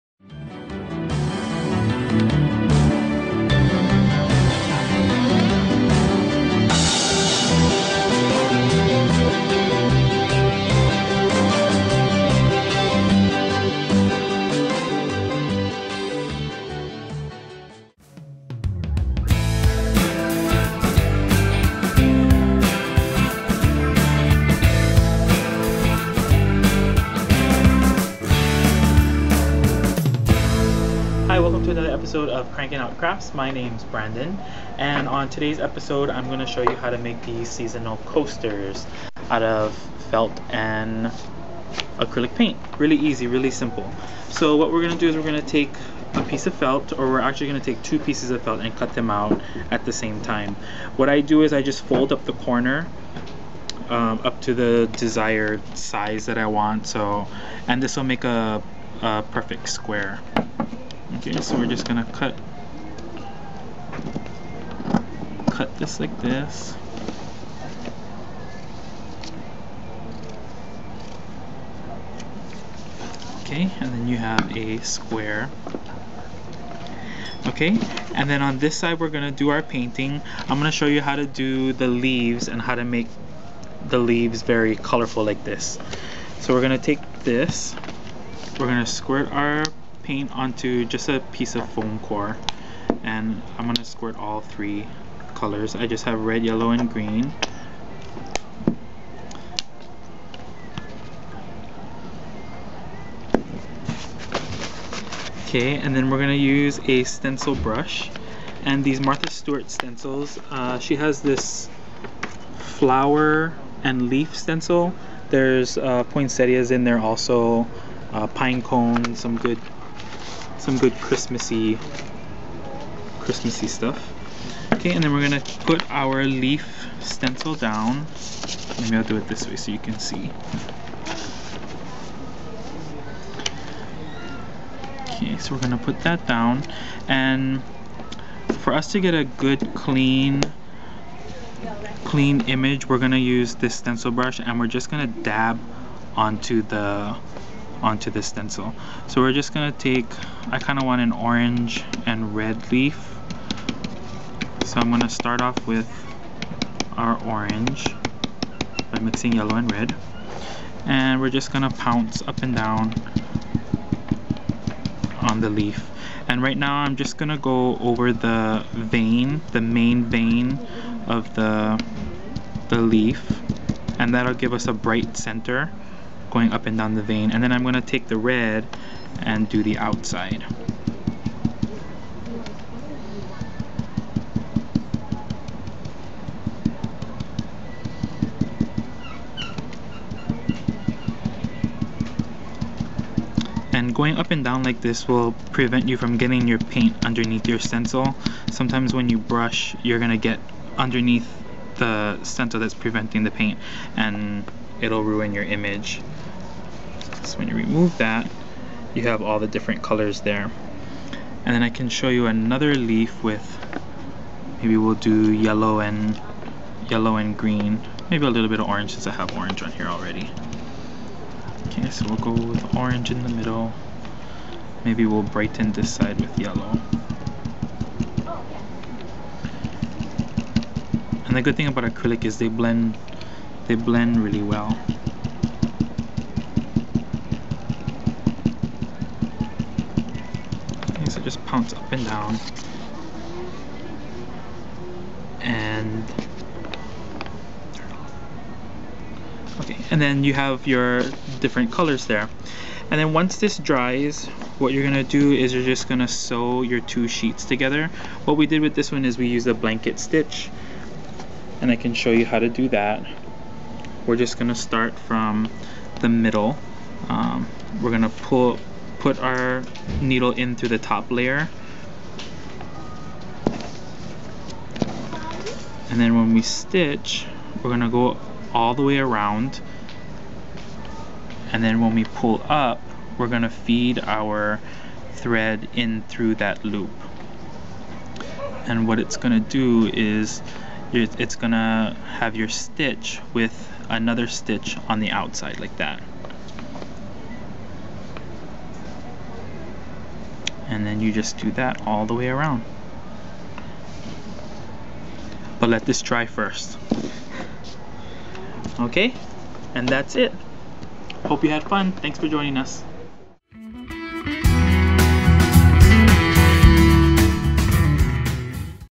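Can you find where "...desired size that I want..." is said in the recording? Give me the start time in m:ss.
0:54.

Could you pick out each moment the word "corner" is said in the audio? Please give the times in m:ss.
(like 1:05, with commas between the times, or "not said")
0:52.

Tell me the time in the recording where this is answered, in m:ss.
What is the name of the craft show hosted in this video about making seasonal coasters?
0:32.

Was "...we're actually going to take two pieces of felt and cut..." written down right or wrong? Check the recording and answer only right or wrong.
right.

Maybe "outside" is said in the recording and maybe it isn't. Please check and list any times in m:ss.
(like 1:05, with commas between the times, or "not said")
2:59, 4:55.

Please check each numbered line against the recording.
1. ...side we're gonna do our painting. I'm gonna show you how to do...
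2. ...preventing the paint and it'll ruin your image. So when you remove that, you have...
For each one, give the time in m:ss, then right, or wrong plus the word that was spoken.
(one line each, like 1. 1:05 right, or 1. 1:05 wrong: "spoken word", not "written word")
1. 1:18 right
2. 3:22 right.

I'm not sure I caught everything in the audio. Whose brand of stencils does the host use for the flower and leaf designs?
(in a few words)
Martha Stewart.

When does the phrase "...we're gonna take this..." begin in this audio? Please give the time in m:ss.
1:26.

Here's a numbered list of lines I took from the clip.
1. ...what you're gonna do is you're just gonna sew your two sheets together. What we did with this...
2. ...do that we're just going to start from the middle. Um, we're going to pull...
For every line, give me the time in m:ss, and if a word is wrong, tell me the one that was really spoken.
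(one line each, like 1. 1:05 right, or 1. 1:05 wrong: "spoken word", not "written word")
1. 4:14 right
2. 4:22 right.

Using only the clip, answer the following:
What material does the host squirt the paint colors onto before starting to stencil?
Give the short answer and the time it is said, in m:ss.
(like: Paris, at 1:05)
foam core, at 1:31.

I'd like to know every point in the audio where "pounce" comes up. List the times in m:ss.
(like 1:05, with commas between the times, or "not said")
2:41, 4:01.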